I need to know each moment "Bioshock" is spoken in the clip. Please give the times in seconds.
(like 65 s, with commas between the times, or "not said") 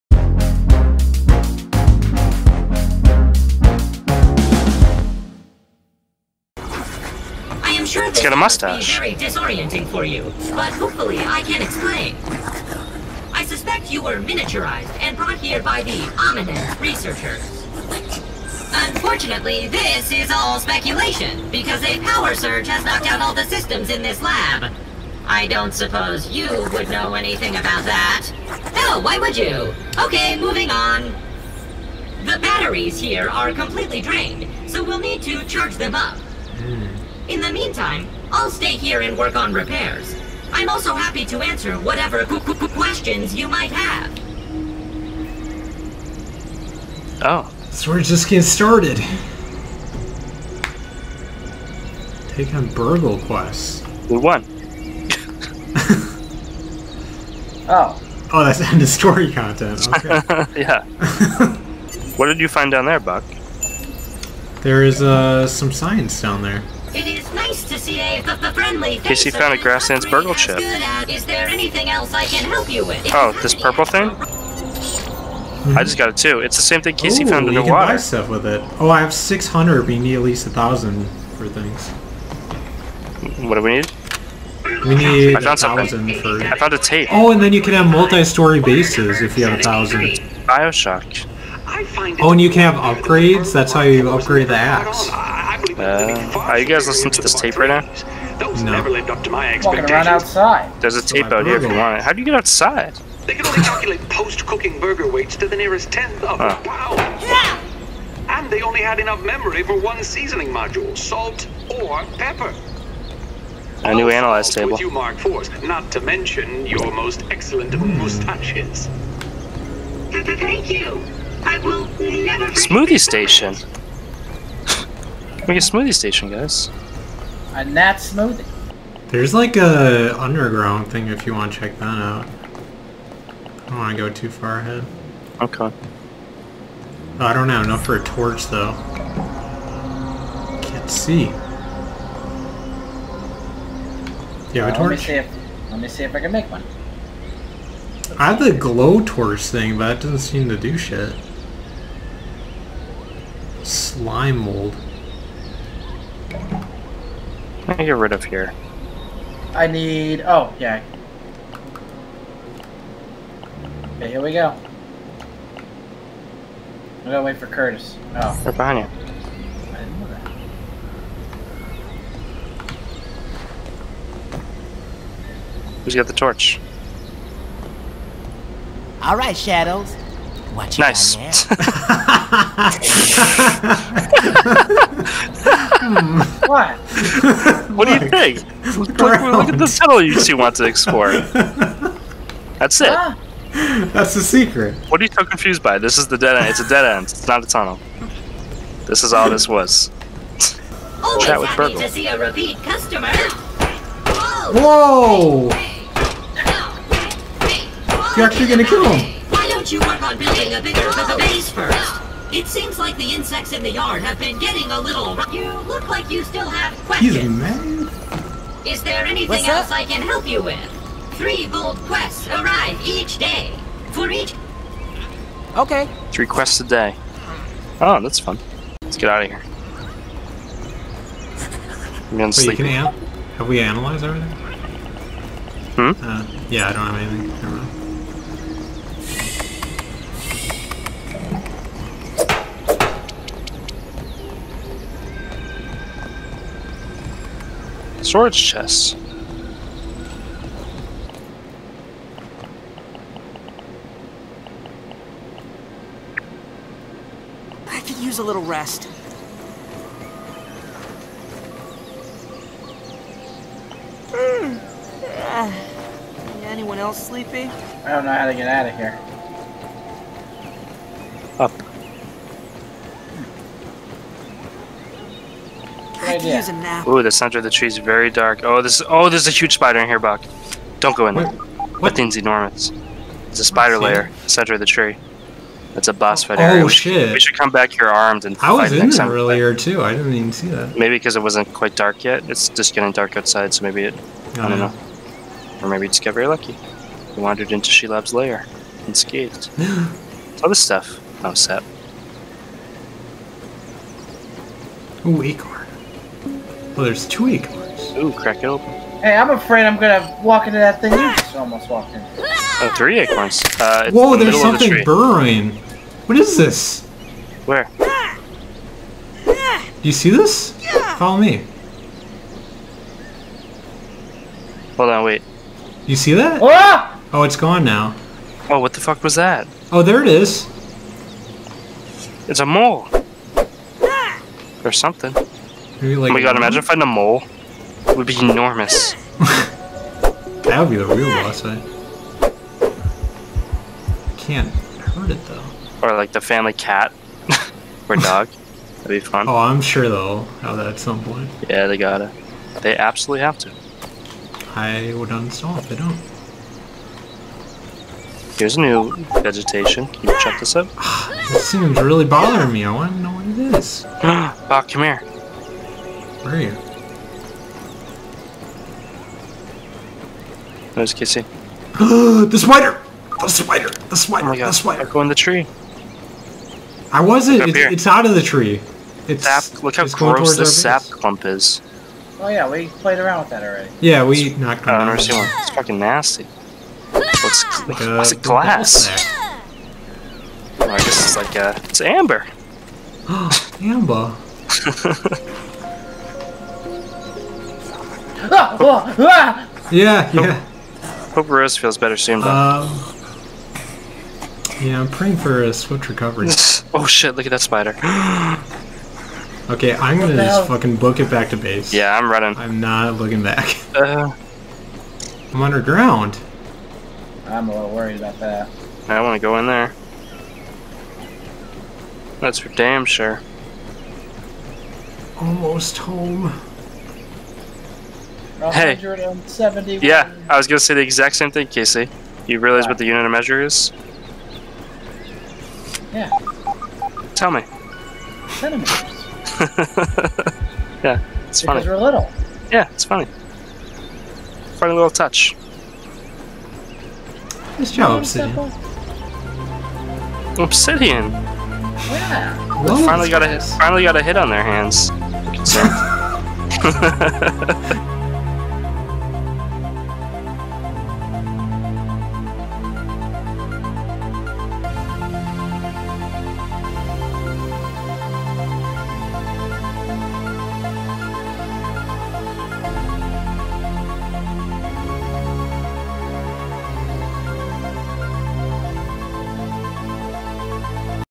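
90 s.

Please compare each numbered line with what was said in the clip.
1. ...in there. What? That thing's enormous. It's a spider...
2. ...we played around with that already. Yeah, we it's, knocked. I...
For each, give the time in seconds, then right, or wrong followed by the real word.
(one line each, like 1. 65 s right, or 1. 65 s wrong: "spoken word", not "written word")
1. 281 s right
2. 382 s right.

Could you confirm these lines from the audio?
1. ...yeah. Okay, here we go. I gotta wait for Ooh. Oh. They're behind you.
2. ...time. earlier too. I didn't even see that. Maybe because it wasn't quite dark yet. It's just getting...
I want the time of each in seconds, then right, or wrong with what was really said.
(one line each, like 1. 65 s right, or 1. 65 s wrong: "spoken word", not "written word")
1. 160 s wrong: "Curtis", not "Ooh"
2. 288 s right.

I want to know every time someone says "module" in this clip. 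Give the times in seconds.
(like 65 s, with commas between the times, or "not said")
110 s.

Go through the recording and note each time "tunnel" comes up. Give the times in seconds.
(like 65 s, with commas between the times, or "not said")
189 s, 197 s.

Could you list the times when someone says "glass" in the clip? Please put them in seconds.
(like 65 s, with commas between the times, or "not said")
388 s.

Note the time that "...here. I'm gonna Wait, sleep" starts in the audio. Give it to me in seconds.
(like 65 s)
229 s.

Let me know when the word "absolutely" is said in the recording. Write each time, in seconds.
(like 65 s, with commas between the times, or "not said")
352 s.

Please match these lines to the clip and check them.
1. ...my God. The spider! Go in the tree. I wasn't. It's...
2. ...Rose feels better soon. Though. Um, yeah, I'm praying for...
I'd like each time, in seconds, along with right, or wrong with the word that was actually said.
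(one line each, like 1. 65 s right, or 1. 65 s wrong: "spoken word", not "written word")
1. 374 s right
2. 401 s right.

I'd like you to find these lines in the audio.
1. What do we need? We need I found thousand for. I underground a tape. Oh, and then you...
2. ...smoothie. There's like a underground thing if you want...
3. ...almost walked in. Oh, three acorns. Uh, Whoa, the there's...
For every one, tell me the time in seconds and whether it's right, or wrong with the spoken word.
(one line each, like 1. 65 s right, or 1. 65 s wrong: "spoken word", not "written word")
1. 83 s wrong: "found", not "underground"
2. 127 s right
3. 311 s right.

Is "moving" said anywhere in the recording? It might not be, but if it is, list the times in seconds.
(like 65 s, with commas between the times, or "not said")
30 s.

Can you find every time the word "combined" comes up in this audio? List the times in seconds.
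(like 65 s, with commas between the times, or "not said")
not said.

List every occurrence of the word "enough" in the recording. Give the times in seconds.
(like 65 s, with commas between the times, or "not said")
108 s, 137 s.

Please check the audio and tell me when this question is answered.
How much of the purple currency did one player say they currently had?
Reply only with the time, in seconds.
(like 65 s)
79 s.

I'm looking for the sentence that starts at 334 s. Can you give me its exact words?
Or something like oh my god, imagine finding a mole.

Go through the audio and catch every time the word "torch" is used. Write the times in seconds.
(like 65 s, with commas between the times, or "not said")
138 s, 144 s, 149 s, 176 s.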